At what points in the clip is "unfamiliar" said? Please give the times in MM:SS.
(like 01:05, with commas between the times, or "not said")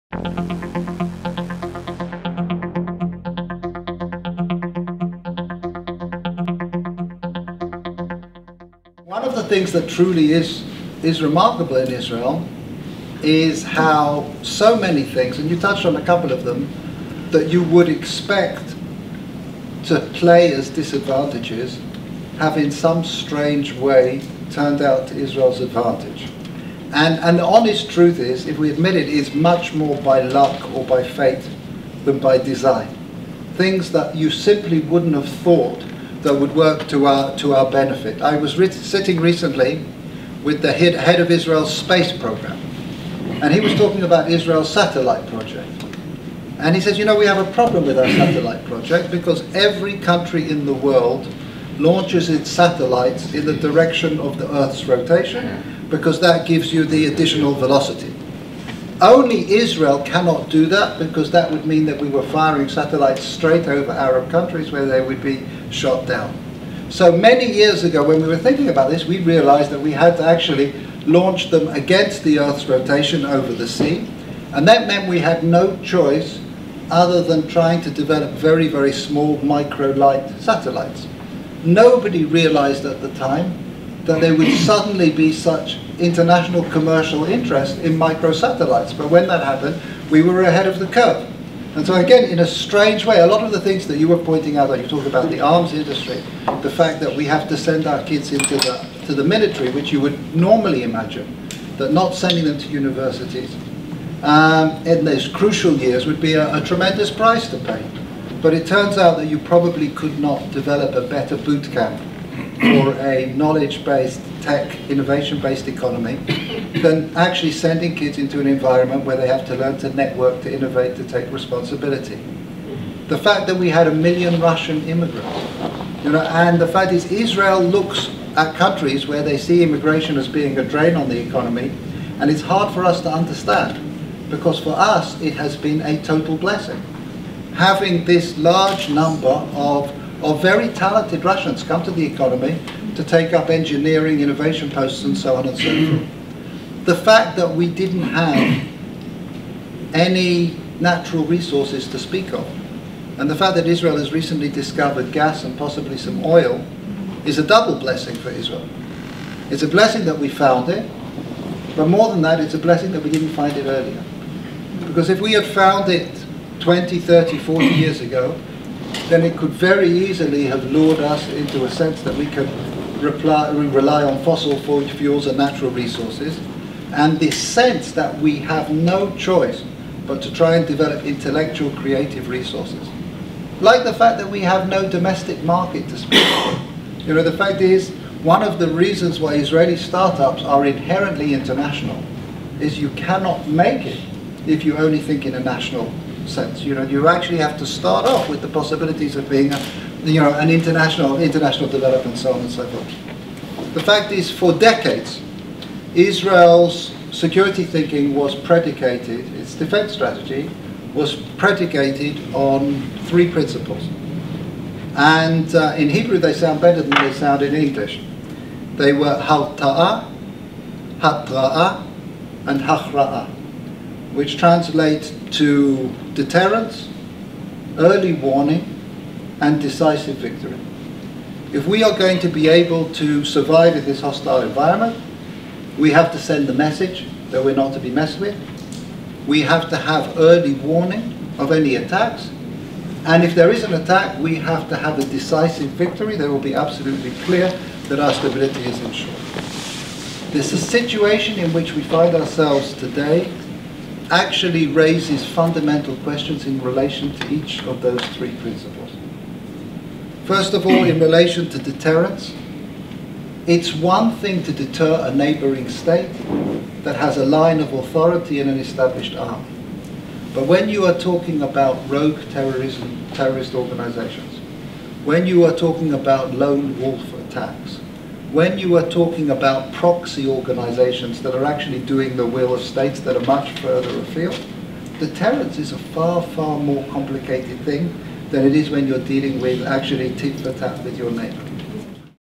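not said.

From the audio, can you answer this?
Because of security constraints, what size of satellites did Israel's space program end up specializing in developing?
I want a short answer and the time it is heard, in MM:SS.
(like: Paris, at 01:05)
micro-light satellites, at 01:19.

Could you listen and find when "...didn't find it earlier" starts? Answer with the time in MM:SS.
02:43.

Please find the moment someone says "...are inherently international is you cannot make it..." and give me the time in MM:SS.
03:10.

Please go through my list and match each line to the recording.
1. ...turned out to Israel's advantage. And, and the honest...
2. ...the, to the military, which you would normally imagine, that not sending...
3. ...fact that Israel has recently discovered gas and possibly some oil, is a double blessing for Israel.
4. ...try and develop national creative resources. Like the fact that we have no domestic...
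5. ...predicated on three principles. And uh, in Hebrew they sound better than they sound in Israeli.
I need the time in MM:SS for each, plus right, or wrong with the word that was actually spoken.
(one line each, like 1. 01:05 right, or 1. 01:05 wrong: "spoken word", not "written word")
1. 00:24 right
2. 01:38 right
3. 02:33 right
4. 03:00 wrong: "intellectual", not "national"
5. 03:31 wrong: "English", not "Israeli".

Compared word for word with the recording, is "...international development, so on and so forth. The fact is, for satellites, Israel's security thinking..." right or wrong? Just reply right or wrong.
wrong.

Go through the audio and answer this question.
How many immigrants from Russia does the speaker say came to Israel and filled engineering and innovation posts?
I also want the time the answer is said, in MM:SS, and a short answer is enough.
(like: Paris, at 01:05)
1 million, at 02:03.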